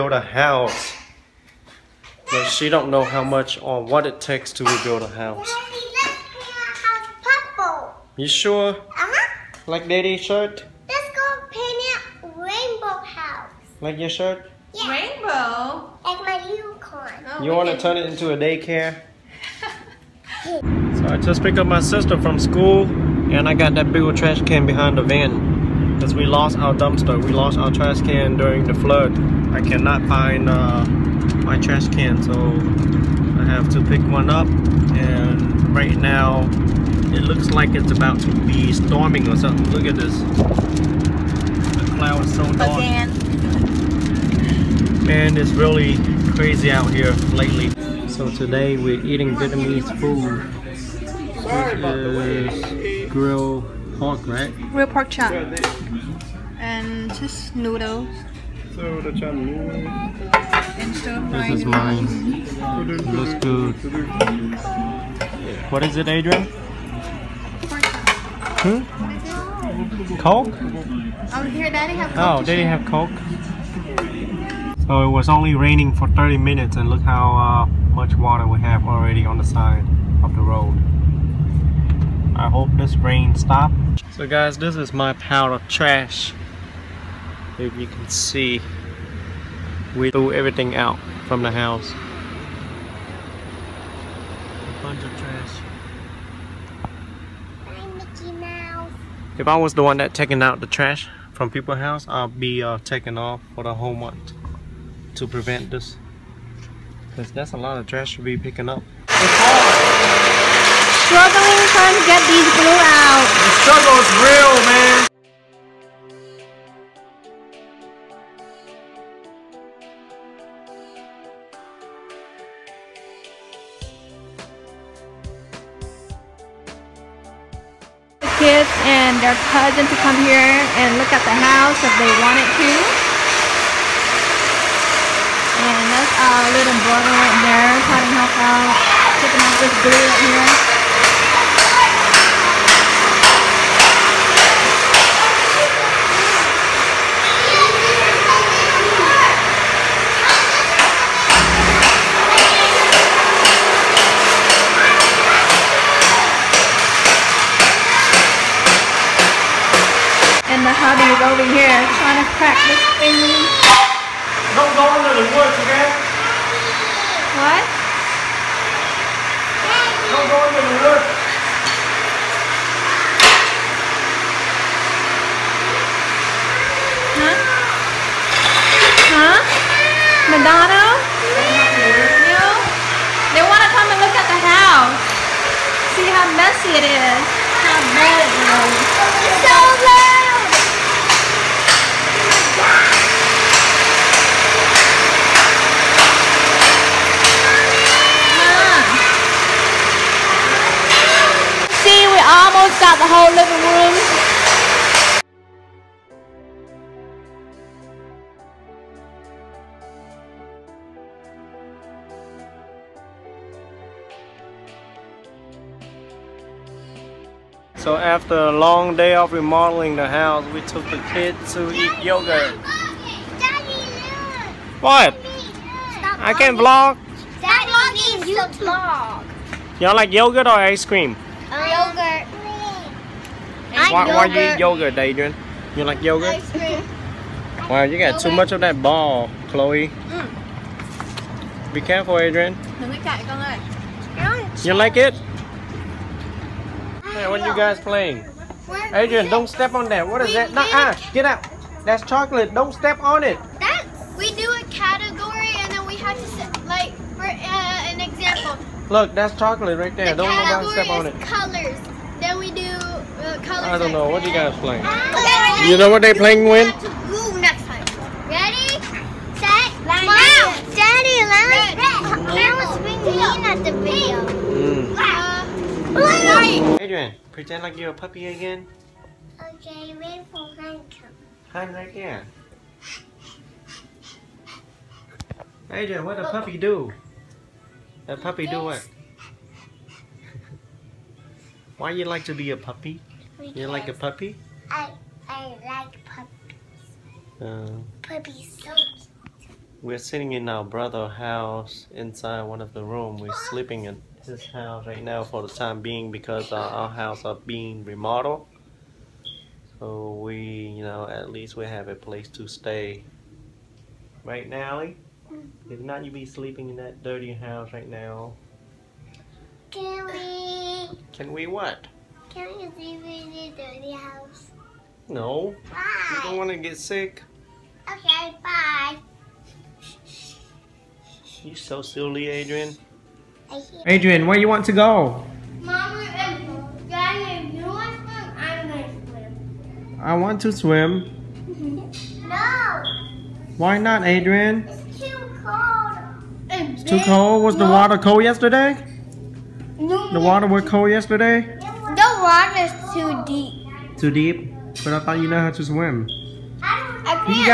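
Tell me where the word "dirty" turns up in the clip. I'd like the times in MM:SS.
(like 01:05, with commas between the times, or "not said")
05:17, 05:23.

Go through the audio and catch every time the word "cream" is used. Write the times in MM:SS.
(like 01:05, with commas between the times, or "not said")
03:50, 03:56.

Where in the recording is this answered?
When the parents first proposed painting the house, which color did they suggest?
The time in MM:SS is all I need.
00:07.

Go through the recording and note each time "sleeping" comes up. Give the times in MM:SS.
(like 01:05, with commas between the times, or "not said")
05:03, 05:16.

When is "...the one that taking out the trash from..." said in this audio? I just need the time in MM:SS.
01:39.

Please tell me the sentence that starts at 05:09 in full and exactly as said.
So we, you know, at least we have a place to stay.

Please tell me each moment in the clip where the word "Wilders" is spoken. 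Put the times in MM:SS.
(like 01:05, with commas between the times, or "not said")
not said.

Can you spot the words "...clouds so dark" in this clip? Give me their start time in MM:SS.
00:41.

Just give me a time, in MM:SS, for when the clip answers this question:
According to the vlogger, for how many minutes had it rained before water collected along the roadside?
01:16.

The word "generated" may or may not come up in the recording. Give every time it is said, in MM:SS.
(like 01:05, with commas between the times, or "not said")
not said.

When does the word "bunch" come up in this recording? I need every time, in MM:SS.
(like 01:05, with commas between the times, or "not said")
01:34.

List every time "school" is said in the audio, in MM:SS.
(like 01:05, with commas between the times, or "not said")
00:22.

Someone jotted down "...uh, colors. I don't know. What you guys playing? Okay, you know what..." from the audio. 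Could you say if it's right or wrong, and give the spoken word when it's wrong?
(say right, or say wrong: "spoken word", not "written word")
right.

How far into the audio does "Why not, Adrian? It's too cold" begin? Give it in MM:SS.
05:43.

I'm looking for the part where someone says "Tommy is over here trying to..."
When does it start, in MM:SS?
02:40.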